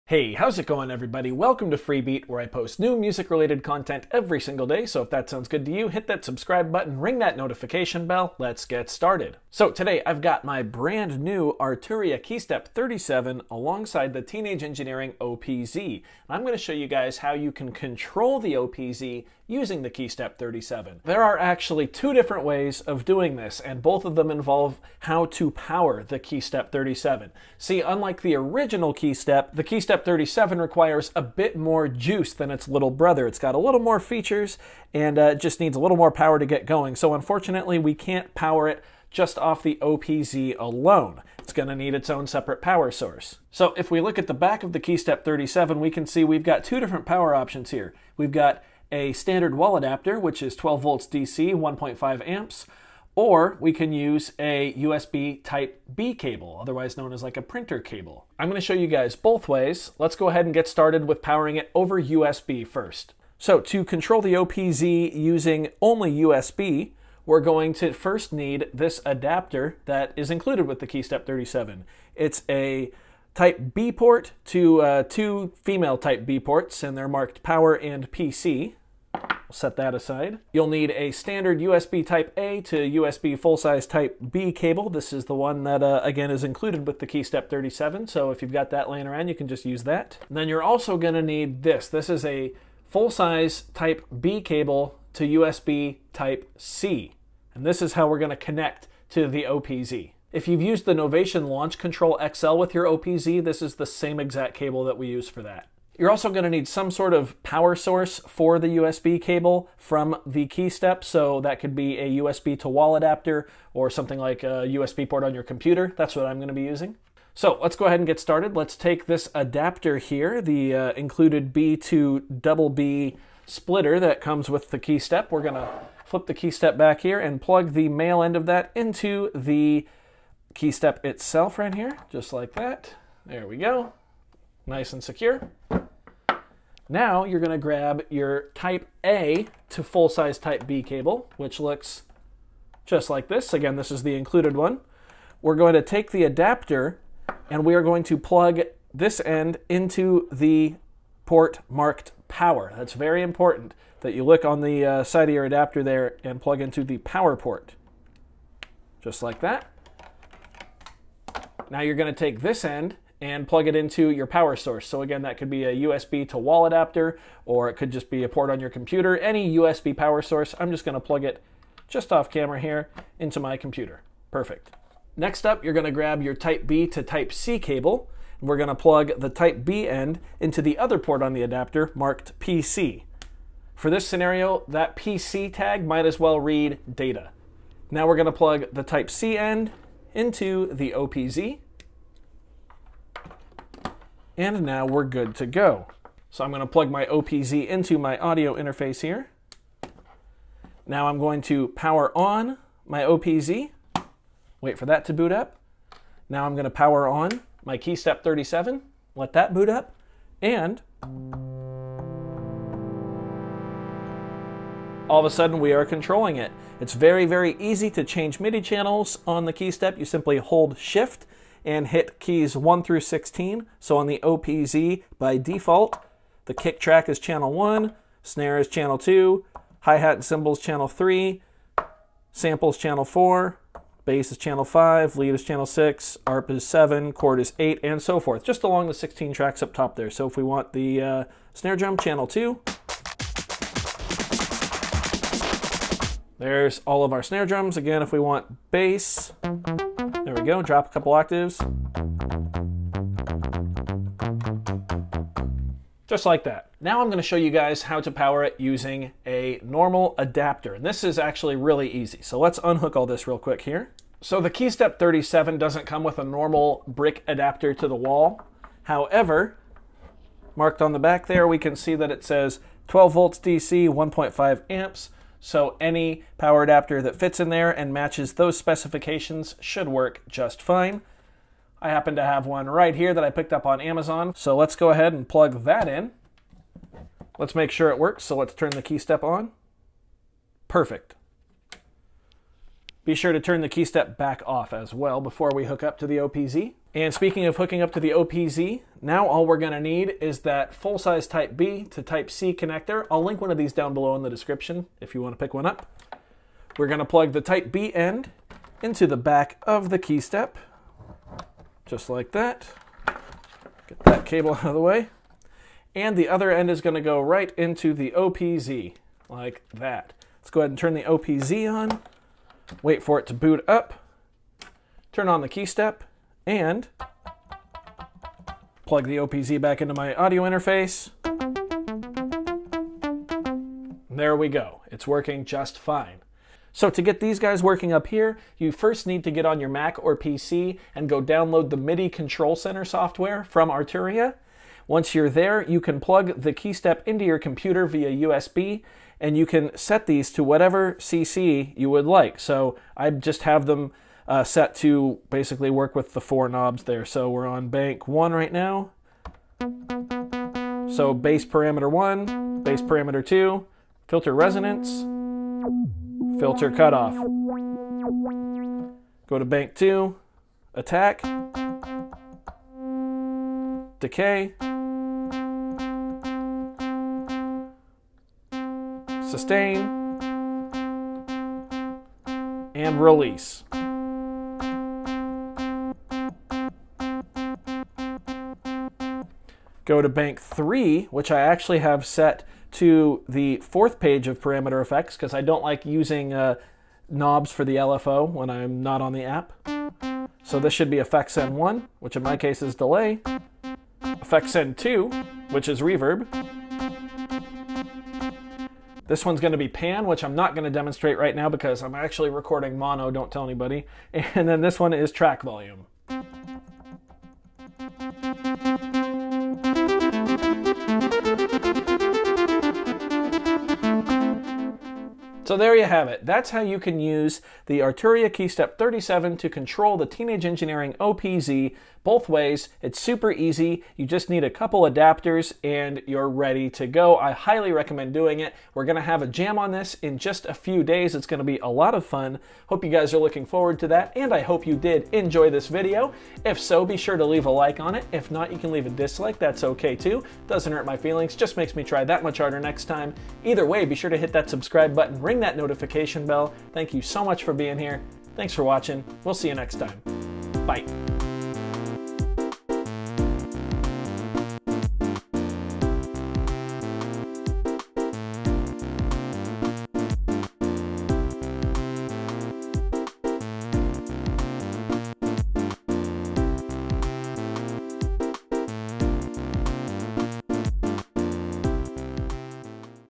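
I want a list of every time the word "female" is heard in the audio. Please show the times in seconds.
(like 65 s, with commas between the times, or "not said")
75 s.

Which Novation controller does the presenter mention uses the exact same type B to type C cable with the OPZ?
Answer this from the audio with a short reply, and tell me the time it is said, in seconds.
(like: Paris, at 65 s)
Launch Control XL, at 101 s.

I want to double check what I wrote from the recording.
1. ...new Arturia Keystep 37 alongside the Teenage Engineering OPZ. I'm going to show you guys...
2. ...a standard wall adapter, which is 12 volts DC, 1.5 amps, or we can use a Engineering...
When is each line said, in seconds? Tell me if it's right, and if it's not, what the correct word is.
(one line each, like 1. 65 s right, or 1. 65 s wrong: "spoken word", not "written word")
1. 11 s right
2. 48 s wrong: "USB", not "Engineering".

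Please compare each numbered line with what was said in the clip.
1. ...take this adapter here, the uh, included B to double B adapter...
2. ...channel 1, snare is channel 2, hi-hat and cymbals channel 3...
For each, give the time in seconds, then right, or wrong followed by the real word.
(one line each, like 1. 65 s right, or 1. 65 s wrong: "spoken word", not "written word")
1. 118 s wrong: "splitter", not "adapter"
2. 227 s right.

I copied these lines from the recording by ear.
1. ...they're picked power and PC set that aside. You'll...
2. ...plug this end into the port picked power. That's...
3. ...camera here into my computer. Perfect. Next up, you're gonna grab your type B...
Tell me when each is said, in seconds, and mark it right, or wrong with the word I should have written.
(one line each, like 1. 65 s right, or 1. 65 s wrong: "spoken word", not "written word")
1. 76 s wrong: "marked", not "picked"
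2. 148 s wrong: "marked", not "picked"
3. 172 s right.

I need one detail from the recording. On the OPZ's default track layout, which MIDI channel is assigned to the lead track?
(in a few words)
6.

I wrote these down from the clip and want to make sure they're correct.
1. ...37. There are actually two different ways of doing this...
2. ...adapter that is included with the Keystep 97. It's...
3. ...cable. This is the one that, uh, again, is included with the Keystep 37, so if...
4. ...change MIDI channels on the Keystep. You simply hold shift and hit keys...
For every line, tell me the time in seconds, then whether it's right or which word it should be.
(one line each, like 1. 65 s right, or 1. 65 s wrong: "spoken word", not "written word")
1. 20 s right
2. 69 s wrong: "37", not "97"
3. 84 s right
4. 218 s right.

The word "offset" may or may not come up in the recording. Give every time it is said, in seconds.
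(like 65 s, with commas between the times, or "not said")
not said.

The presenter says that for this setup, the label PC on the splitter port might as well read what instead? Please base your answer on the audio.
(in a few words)
data.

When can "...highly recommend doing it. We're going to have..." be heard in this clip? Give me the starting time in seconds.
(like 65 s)
437 s.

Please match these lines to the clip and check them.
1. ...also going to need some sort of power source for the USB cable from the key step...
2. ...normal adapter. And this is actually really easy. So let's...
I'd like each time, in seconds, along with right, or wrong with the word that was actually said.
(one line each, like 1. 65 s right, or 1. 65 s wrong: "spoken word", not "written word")
1. 106 s right
2. 259 s right.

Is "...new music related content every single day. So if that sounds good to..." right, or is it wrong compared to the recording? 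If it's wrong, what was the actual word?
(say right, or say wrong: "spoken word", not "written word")
right.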